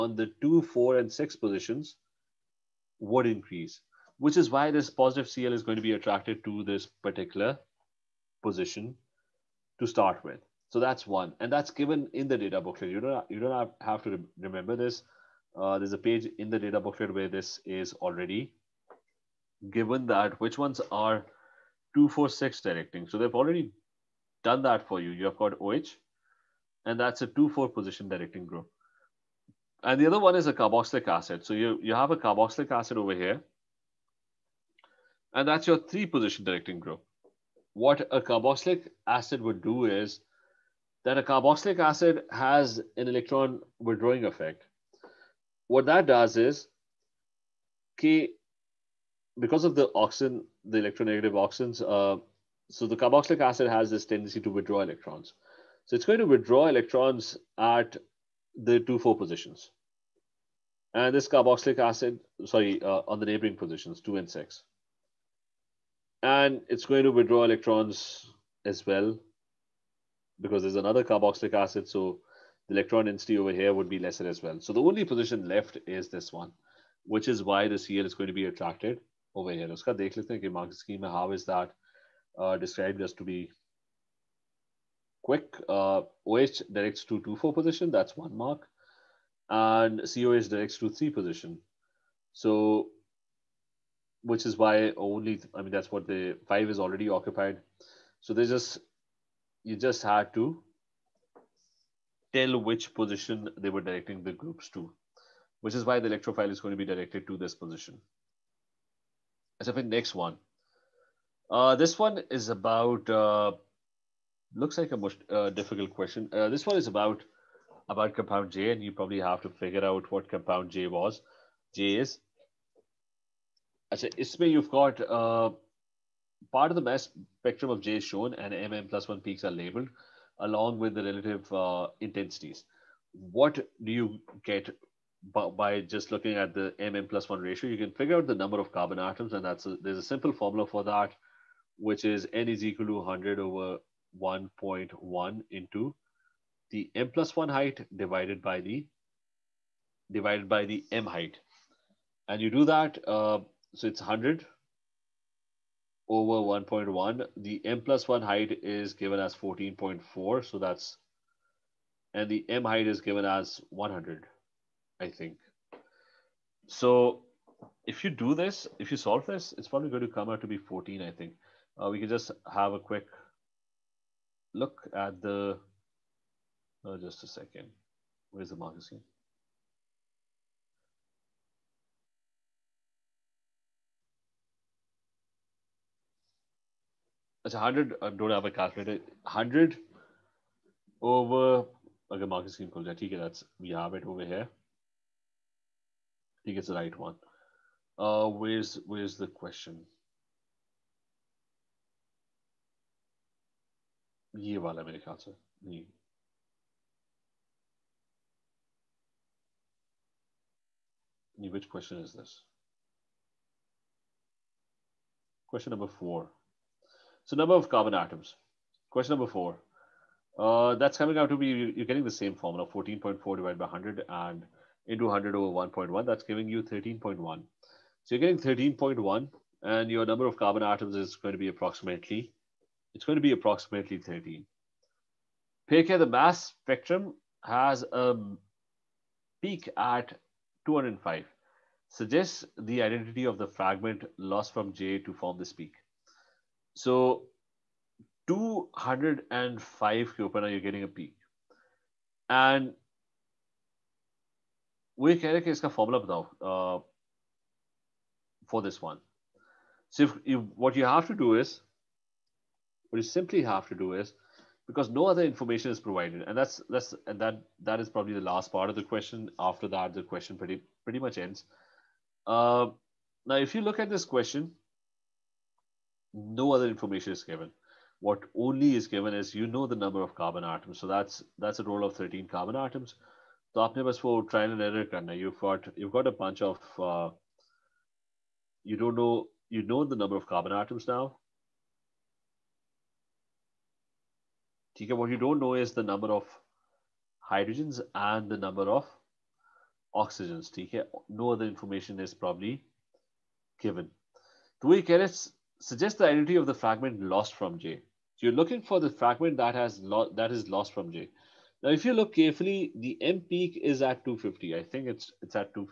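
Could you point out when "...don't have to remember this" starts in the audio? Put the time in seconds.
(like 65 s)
13 s.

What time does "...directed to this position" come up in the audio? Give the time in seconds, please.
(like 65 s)
106 s.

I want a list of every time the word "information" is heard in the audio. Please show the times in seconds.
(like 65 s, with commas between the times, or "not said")
265 s, 276 s, 301 s.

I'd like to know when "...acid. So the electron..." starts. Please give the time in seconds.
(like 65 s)
71 s.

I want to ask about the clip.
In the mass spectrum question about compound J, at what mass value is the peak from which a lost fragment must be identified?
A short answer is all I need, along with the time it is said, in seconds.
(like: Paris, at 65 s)
205, at 237 s.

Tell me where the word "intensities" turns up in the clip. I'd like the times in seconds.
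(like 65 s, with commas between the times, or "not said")
132 s.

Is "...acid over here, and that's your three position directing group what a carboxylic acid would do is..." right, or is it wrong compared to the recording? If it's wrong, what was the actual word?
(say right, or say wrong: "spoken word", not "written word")
right.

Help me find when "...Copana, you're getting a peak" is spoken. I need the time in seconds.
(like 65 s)
250 s.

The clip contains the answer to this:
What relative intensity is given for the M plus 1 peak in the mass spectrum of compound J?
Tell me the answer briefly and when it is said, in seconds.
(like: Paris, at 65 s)
14.4, at 157 s.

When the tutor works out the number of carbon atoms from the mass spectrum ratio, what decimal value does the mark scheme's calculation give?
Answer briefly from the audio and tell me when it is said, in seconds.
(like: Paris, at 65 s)
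13.1, at 226 s.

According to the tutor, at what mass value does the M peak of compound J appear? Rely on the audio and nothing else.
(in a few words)
250.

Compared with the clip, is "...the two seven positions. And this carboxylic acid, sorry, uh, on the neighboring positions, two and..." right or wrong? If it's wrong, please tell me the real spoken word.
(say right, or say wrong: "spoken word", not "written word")
wrong: "four", not "seven".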